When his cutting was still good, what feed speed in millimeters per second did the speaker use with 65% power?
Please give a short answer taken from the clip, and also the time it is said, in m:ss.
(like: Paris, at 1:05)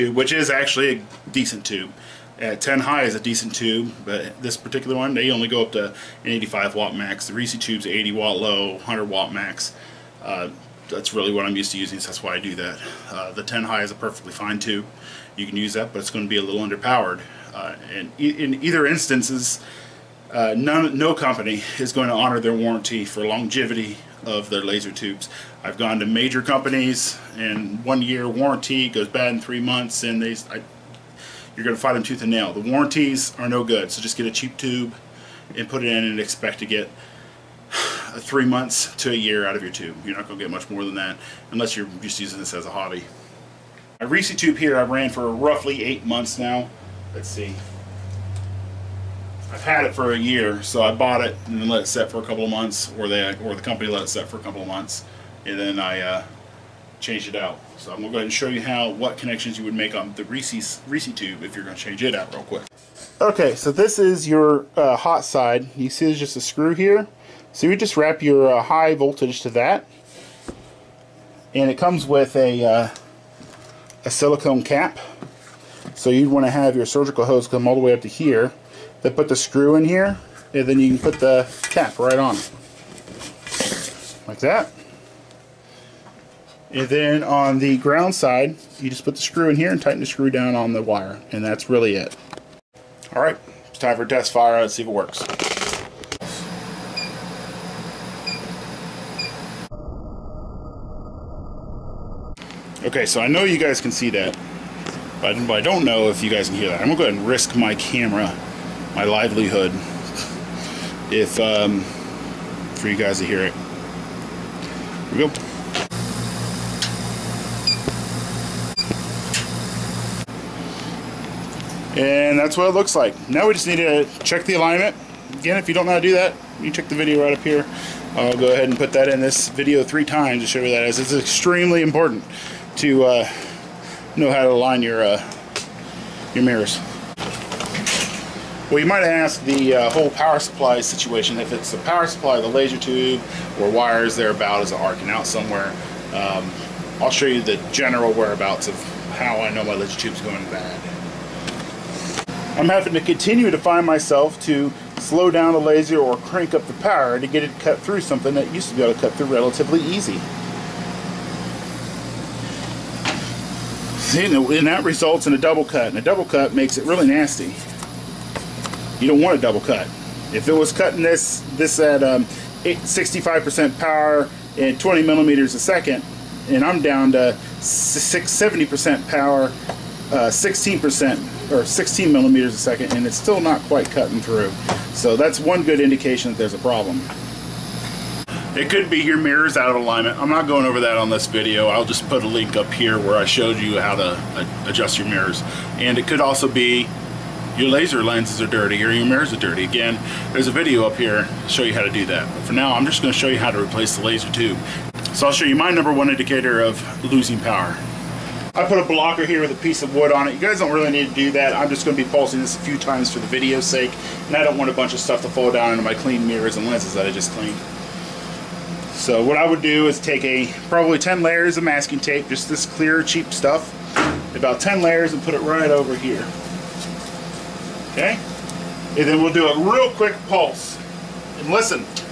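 20 millimeters a second, at 2:54.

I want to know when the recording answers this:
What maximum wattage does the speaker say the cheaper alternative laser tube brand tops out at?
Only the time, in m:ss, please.
0:06.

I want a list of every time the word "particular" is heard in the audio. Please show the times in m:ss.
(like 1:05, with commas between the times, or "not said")
0:04.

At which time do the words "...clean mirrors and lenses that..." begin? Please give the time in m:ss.
3:35.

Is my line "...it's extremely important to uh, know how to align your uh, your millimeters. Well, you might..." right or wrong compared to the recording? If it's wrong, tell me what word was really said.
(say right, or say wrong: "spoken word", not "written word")
wrong: "mirrors", not "millimeters".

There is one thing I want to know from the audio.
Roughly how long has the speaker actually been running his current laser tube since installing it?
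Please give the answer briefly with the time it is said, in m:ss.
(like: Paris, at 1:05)
8 months, at 0:45.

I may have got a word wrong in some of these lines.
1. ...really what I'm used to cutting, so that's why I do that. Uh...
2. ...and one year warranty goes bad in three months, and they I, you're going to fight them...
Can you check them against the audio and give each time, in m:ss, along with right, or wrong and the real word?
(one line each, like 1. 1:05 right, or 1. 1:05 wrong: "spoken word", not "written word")
1. 0:11 wrong: "using", not "cutting"
2. 0:27 right.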